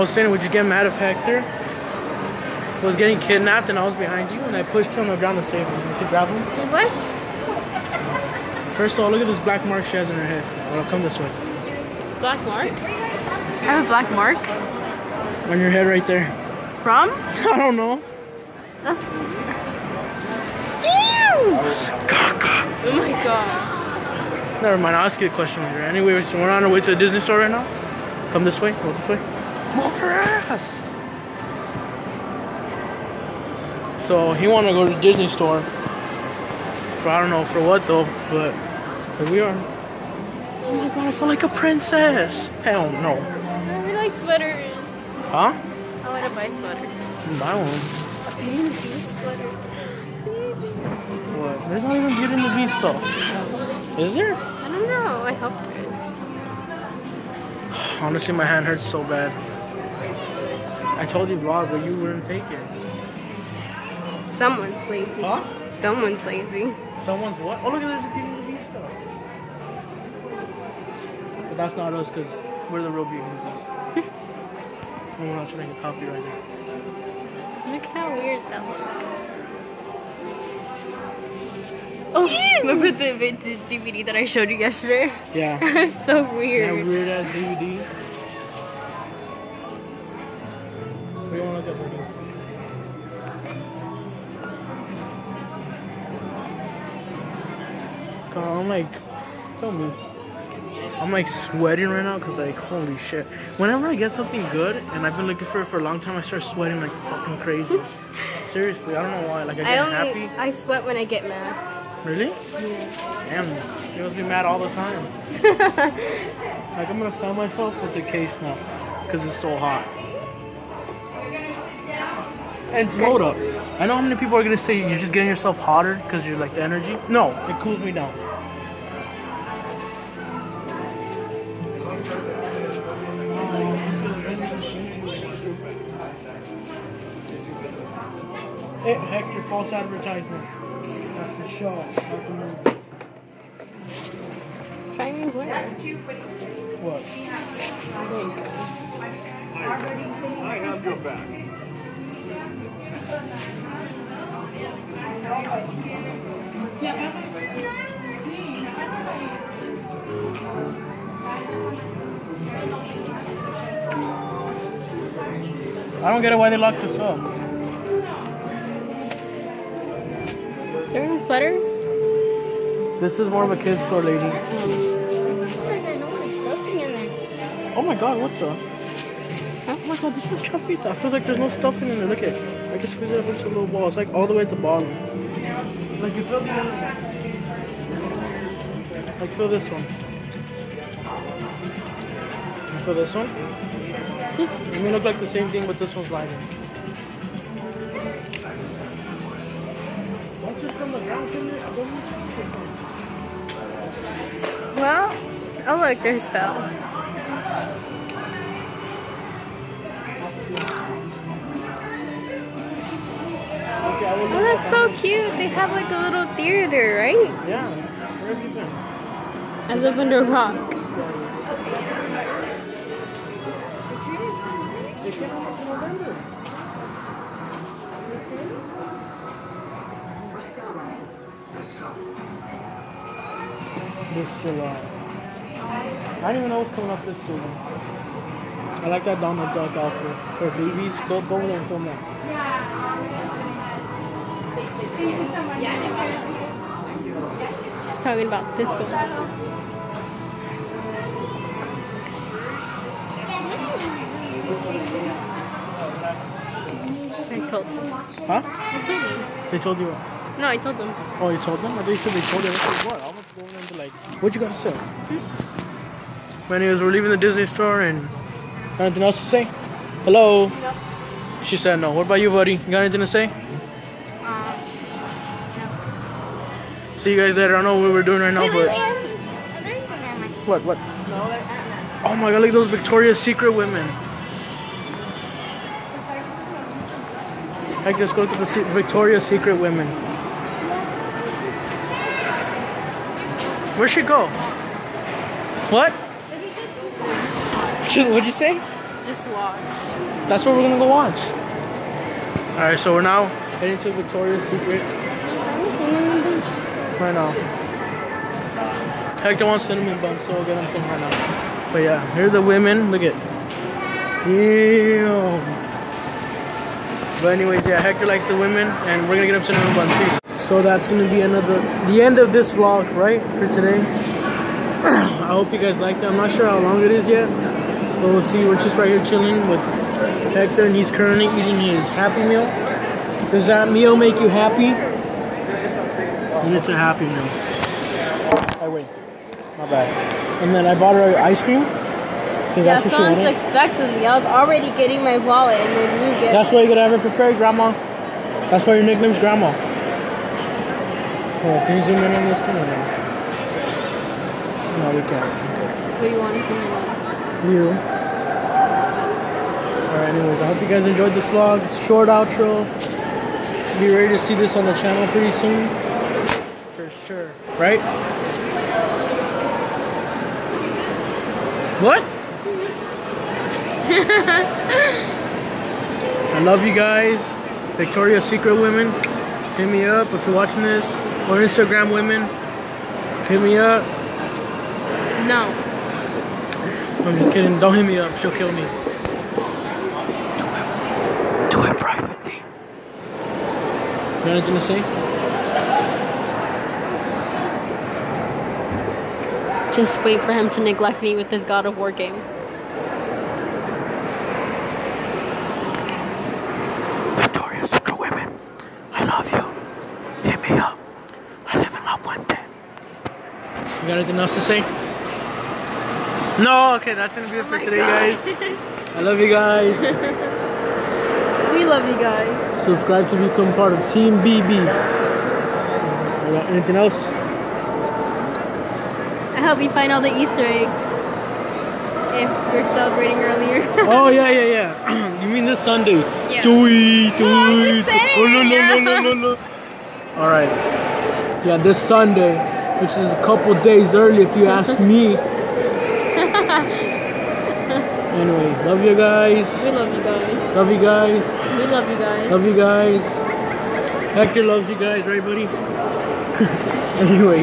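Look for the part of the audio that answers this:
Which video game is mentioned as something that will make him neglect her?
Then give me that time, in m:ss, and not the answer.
6:41.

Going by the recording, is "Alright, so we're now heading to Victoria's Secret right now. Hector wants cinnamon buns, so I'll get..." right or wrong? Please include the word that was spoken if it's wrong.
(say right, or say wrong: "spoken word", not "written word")
right.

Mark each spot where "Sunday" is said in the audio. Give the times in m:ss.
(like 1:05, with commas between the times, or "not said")
7:15, 7:21.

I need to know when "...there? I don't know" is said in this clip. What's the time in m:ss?
0:54.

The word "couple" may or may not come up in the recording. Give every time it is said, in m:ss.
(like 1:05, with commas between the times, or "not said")
7:23.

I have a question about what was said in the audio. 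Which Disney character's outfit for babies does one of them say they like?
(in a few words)
Donald Duck.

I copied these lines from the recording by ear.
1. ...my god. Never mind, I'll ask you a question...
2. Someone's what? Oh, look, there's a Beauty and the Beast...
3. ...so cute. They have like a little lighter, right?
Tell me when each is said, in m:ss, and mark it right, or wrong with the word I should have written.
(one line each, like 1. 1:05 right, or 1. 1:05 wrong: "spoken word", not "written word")
1. 0:22 right
2. 1:07 right
3. 3:34 wrong: "theater", not "lighter".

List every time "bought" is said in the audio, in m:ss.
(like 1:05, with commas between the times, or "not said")
5:40.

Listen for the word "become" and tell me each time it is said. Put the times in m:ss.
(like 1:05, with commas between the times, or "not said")
7:03.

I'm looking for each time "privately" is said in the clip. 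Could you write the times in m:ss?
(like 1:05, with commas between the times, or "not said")
6:31.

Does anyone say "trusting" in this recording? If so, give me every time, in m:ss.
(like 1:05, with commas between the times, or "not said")
not said.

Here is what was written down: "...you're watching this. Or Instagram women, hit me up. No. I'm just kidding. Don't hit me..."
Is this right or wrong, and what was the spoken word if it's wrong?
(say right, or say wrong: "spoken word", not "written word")
right.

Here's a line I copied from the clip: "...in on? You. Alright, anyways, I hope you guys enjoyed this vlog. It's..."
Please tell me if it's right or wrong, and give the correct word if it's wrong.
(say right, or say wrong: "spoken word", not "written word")
right.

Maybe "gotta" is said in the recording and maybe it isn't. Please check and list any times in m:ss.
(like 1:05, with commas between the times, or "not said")
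5:46.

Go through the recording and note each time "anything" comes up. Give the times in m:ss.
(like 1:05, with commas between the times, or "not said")
4:28, 4:32, 6:34, 6:53, 7:06.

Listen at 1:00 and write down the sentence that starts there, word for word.
I told you vlog, but you wouldn't take it.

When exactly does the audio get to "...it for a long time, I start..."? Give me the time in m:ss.
1:45.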